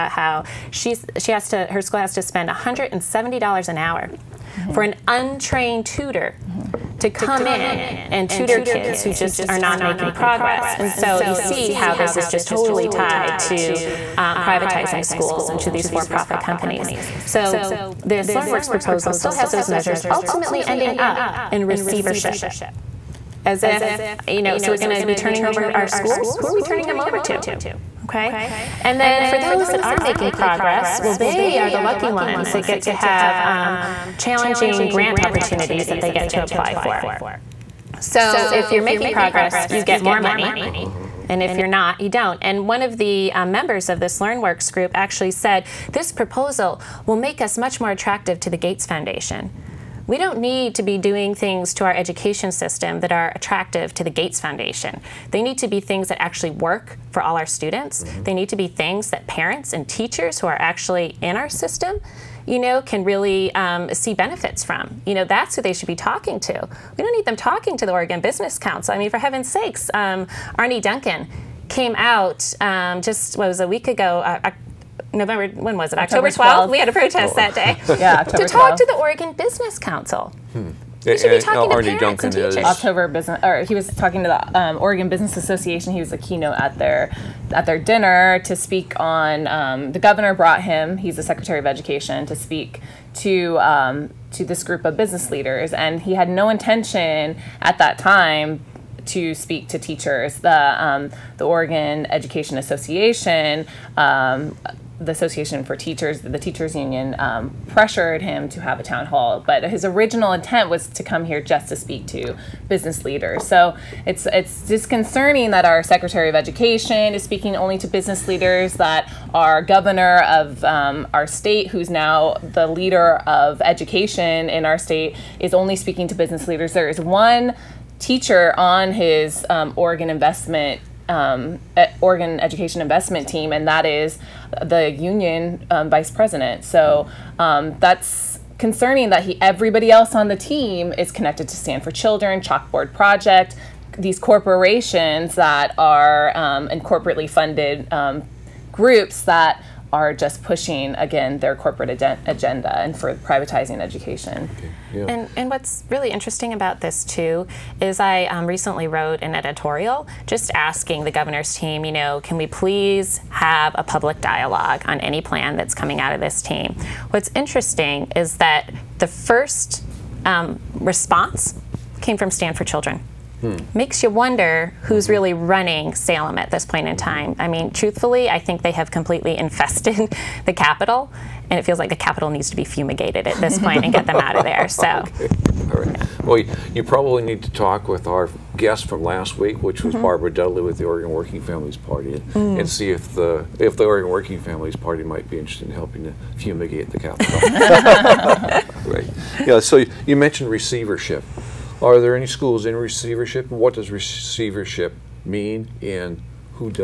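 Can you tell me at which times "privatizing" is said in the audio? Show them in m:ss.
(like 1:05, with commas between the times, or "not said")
0:14, 2:33.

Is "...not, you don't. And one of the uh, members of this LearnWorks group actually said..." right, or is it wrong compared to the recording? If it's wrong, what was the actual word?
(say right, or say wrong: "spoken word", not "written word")
right.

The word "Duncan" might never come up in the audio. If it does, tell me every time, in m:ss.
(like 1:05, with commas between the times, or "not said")
1:10, 1:22.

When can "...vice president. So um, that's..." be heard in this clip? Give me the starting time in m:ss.
2:15.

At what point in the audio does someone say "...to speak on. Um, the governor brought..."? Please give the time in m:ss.
1:28.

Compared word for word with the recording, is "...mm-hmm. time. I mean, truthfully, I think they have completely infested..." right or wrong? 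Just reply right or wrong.
right.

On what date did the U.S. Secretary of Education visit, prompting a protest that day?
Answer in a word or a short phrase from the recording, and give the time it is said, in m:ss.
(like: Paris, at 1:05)
October 12, at 1:16.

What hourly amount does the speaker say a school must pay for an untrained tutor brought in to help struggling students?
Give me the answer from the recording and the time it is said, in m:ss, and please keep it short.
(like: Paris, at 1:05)
$170, at 0:02.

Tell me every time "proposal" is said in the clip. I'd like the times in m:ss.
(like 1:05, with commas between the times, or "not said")
0:18, 0:46.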